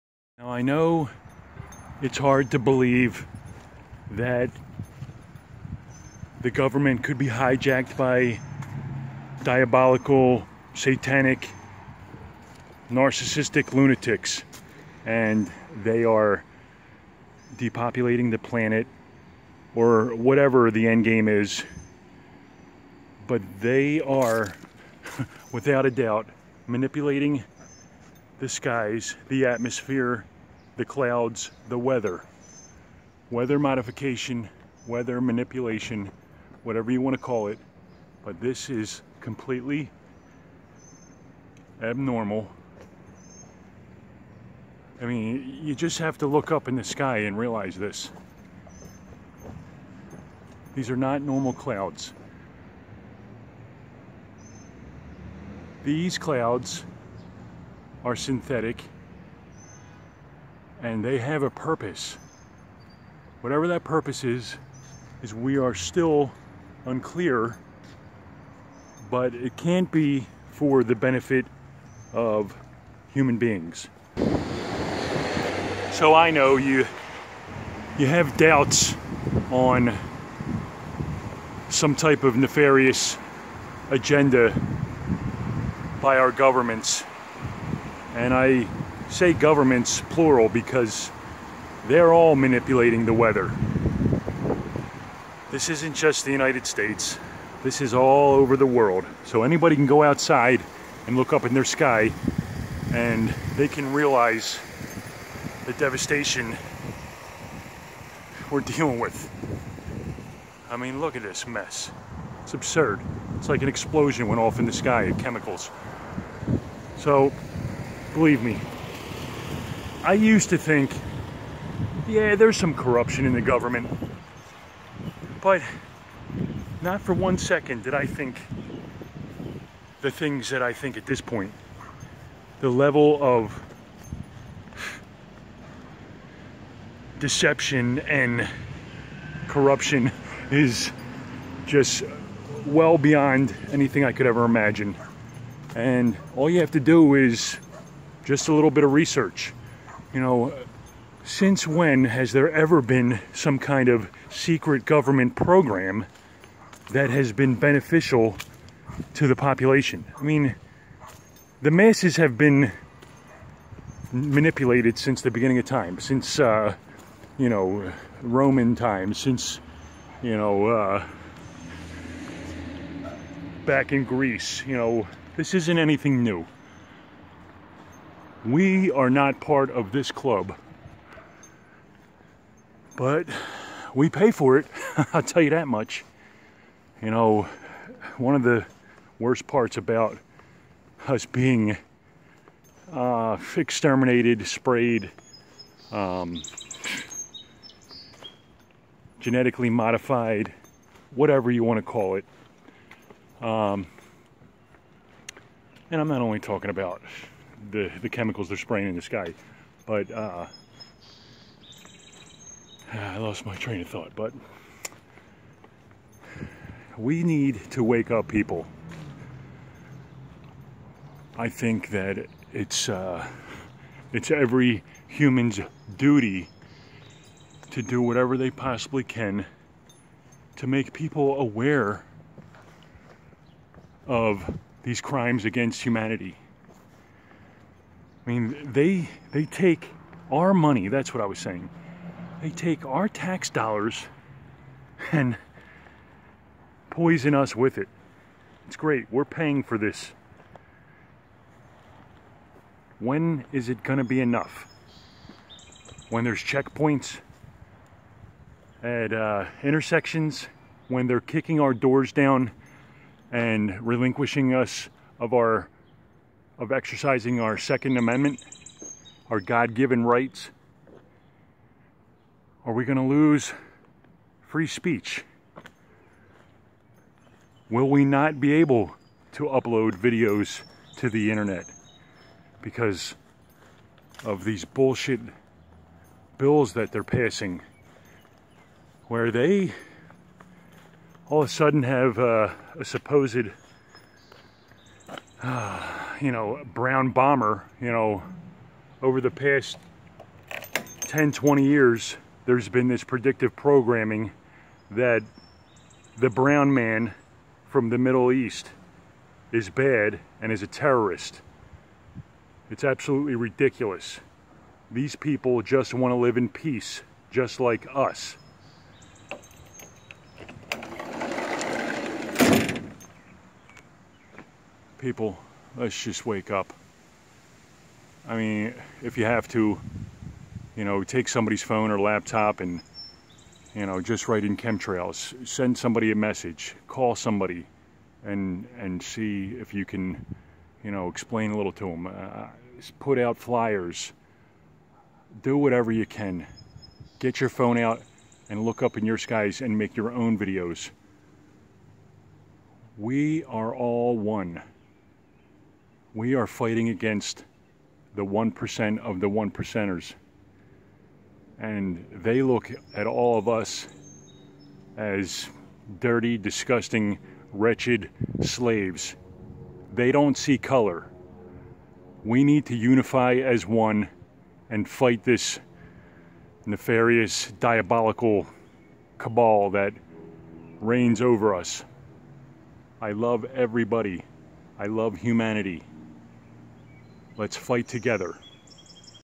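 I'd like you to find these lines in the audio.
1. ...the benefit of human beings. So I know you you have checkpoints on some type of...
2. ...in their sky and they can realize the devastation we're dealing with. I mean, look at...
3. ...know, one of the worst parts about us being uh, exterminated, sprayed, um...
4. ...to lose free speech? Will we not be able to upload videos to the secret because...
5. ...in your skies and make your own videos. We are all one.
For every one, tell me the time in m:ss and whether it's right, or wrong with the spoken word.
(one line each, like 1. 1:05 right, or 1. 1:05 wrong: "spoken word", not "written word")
1. 1:10 wrong: "doubts", not "checkpoints"
2. 1:41 right
3. 3:07 right
4. 4:32 wrong: "internet", not "secret"
5. 5:48 right.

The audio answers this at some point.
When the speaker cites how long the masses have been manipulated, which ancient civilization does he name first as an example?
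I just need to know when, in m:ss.
2:48.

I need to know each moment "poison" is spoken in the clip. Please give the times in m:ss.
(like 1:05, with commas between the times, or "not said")
4:06.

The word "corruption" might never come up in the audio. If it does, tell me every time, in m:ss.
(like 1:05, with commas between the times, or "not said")
2:02, 2:19.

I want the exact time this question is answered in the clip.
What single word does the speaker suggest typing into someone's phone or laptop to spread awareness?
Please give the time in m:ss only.
5:34.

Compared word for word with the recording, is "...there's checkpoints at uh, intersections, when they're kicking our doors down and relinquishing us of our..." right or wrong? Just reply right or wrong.
right.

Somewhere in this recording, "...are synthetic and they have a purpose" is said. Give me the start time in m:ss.
0:58.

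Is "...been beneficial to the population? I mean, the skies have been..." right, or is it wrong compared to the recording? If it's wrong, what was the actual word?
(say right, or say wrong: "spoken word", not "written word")
wrong: "masses", not "skies".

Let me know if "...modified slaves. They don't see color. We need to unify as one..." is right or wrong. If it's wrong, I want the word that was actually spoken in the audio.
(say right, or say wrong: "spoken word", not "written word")
wrong: "wretched", not "modified".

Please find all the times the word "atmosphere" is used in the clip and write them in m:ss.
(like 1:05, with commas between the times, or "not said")
0:29.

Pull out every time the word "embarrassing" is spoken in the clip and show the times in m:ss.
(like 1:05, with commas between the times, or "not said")
not said.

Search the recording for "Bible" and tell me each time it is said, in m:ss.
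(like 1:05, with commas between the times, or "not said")
not said.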